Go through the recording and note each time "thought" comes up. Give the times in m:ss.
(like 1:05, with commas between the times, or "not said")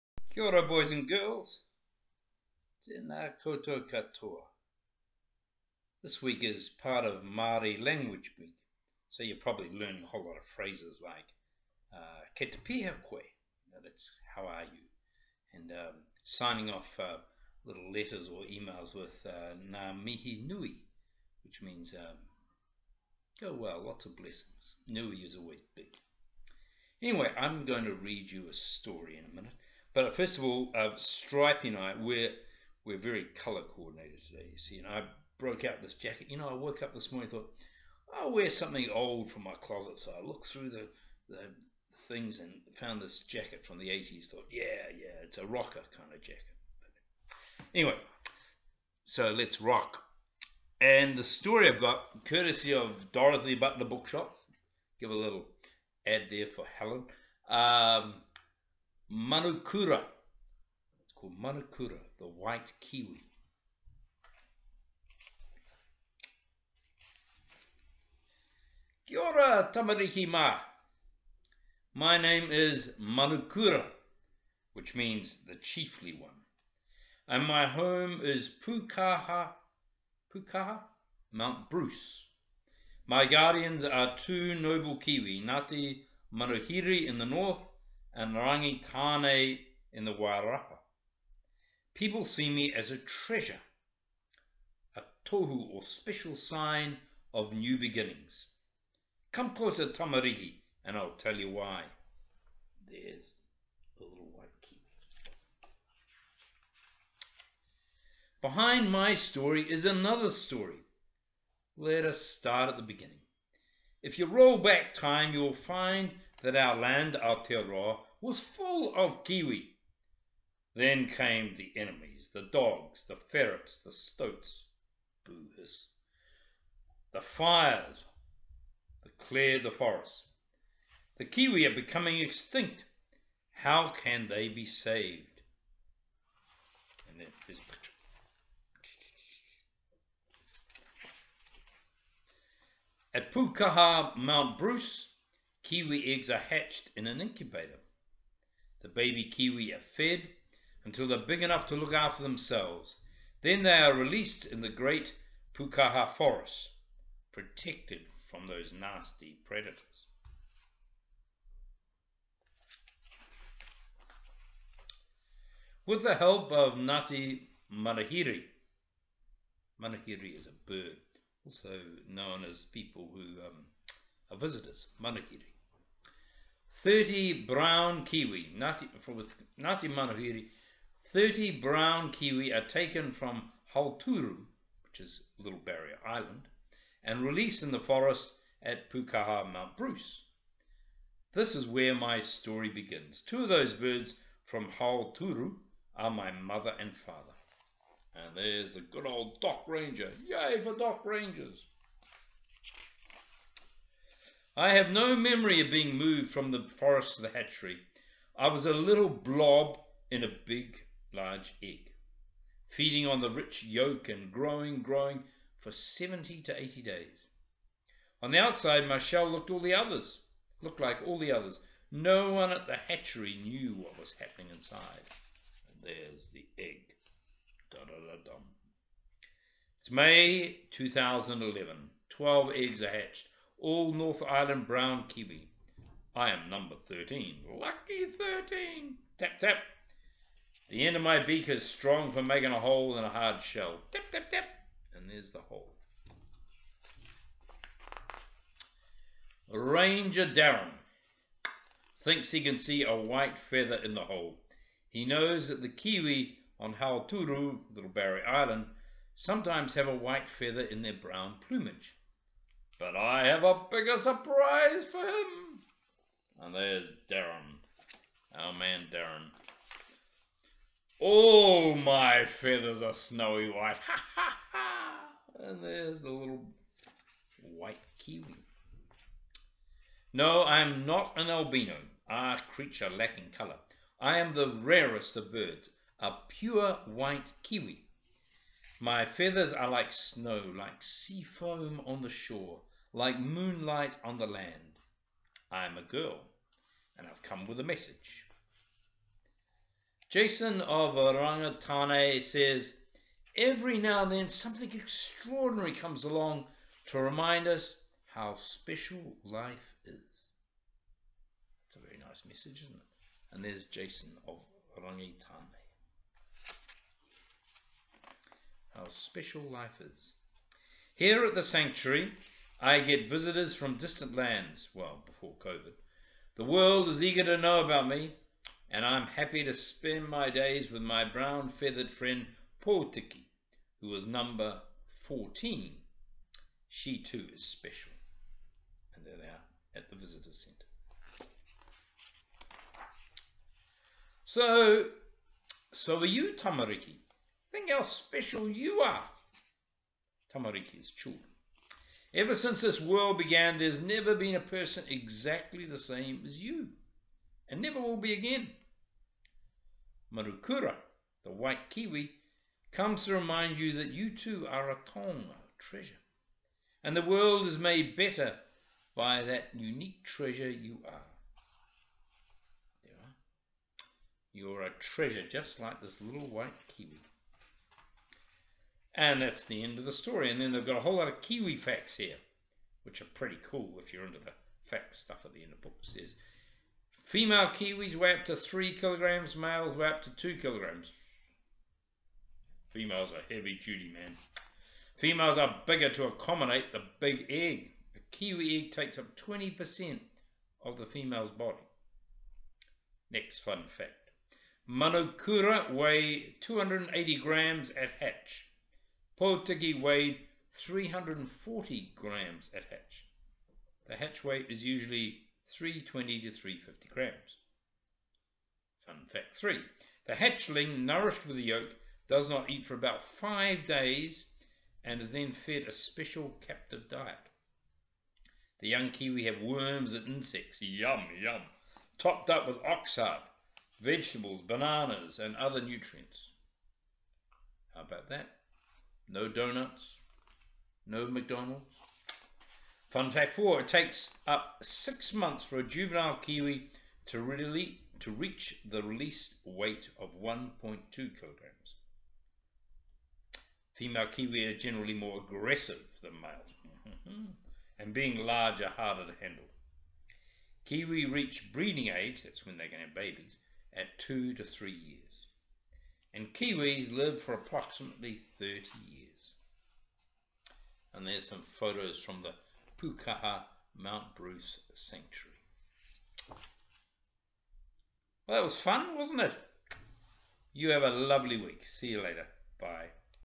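0:37, 0:44.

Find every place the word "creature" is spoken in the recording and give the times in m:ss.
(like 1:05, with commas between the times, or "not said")
4:42.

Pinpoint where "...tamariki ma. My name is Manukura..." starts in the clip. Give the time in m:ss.
1:09.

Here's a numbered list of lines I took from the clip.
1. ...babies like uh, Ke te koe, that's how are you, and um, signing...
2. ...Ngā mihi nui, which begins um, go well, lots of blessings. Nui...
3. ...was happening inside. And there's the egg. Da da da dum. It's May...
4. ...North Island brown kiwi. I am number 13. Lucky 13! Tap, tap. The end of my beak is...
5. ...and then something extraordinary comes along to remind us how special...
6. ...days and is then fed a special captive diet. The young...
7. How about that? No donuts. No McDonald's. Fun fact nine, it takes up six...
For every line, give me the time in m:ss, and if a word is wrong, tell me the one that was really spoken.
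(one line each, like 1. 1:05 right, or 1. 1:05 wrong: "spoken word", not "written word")
1. 0:10 wrong: "phrases", not "babies"
2. 0:19 wrong: "means", not "begins"
3. 3:43 right
4. 3:53 right
5. 5:04 right
6. 7:03 right
7. 7:17 wrong: "four", not "nine".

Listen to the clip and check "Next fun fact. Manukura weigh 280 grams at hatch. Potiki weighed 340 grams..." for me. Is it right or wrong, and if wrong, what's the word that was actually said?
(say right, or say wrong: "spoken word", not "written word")
right.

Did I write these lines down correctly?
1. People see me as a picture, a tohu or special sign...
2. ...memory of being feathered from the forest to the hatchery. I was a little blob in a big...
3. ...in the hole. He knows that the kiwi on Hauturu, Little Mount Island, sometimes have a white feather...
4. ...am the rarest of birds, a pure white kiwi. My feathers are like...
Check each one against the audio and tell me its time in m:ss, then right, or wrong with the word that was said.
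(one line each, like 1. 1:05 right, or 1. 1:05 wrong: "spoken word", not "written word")
1. 1:31 wrong: "treasure", not "picture"
2. 3:25 wrong: "moved", not "feathered"
3. 4:13 wrong: "Barrier", not "Mount"
4. 4:44 right.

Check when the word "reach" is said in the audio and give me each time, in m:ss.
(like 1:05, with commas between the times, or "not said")
7:28, 7:41.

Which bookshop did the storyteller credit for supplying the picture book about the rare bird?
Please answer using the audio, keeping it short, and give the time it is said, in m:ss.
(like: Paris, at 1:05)
Dorothy Butler Bookshop, at 0:53.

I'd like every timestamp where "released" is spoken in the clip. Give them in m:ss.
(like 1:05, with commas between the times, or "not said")
2:33, 3:07, 7:28.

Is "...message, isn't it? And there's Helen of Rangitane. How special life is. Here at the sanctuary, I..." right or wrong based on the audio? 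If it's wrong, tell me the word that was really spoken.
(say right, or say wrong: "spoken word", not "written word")
wrong: "Jason", not "Helen".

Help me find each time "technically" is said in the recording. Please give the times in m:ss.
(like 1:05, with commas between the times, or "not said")
not said.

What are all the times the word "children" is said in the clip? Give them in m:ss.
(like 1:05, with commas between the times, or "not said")
5:50.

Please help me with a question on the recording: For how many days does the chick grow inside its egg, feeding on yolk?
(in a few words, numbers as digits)
70 to 80 days.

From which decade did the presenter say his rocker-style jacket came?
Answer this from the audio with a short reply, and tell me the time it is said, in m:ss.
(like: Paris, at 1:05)
the 80s, at 0:43.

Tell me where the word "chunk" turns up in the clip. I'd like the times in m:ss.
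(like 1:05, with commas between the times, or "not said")
not said.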